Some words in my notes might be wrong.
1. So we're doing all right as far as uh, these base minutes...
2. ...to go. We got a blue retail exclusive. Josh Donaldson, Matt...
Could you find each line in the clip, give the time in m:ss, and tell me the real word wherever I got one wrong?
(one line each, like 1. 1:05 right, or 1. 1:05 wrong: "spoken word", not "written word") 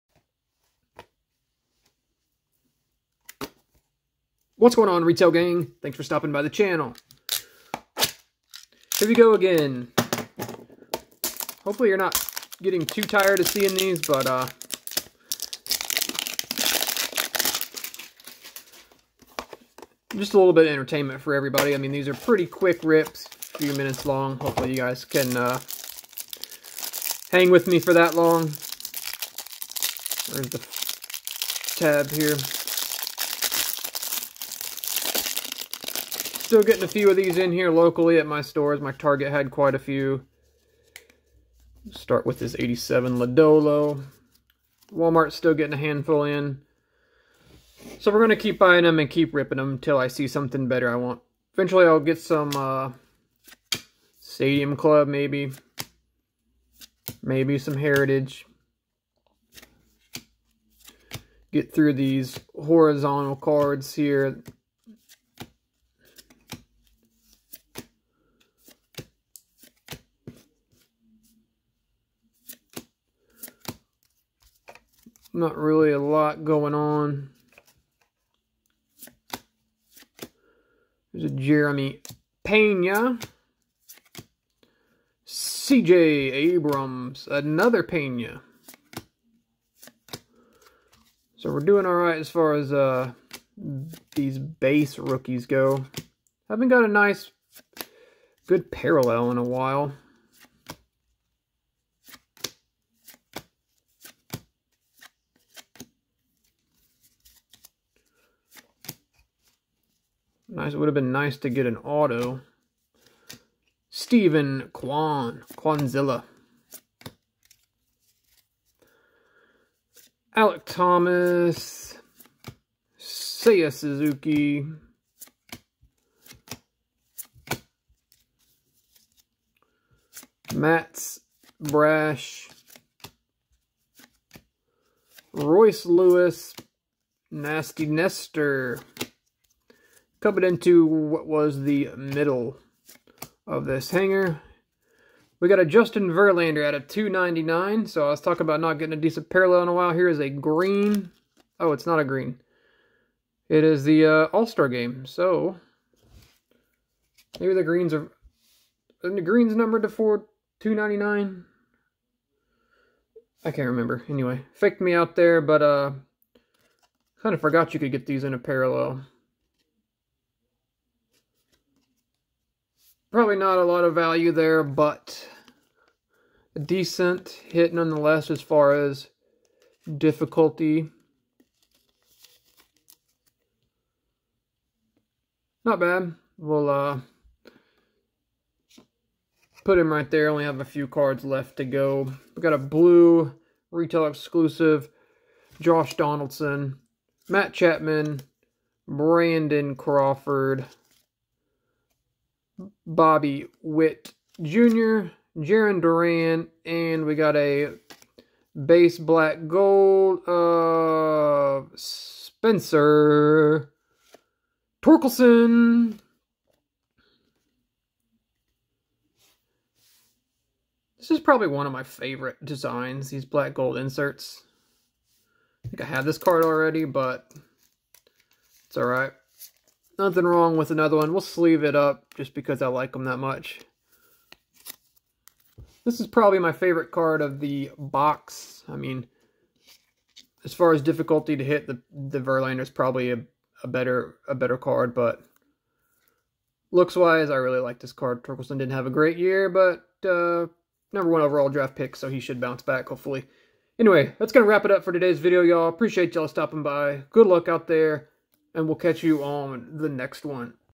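1. 1:31 wrong: "rookies", not "minutes"
2. 3:11 right.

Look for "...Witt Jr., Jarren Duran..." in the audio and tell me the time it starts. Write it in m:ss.
3:23.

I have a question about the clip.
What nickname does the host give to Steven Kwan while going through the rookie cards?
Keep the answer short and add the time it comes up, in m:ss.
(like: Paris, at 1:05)
Kwanzilla, at 1:55.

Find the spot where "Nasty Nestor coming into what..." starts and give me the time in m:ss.
2:17.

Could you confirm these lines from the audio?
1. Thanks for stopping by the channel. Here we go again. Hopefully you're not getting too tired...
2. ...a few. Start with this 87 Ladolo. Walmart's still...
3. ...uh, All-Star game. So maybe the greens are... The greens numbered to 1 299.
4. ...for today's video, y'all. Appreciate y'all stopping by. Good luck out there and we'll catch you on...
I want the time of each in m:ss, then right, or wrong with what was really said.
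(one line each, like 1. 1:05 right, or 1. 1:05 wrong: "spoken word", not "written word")
1. 0:05 right
2. 0:39 right
3. 2:34 wrong: "4", not "1"
4. 4:14 right.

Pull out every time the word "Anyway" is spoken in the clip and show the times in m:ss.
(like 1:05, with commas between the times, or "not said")
2:44, 4:13.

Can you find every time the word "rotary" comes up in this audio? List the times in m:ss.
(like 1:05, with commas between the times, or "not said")
not said.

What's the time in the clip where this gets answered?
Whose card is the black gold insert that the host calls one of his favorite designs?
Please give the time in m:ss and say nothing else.
3:31.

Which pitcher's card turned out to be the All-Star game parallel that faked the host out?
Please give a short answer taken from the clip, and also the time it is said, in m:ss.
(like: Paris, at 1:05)
Justin Verlander, at 2:25.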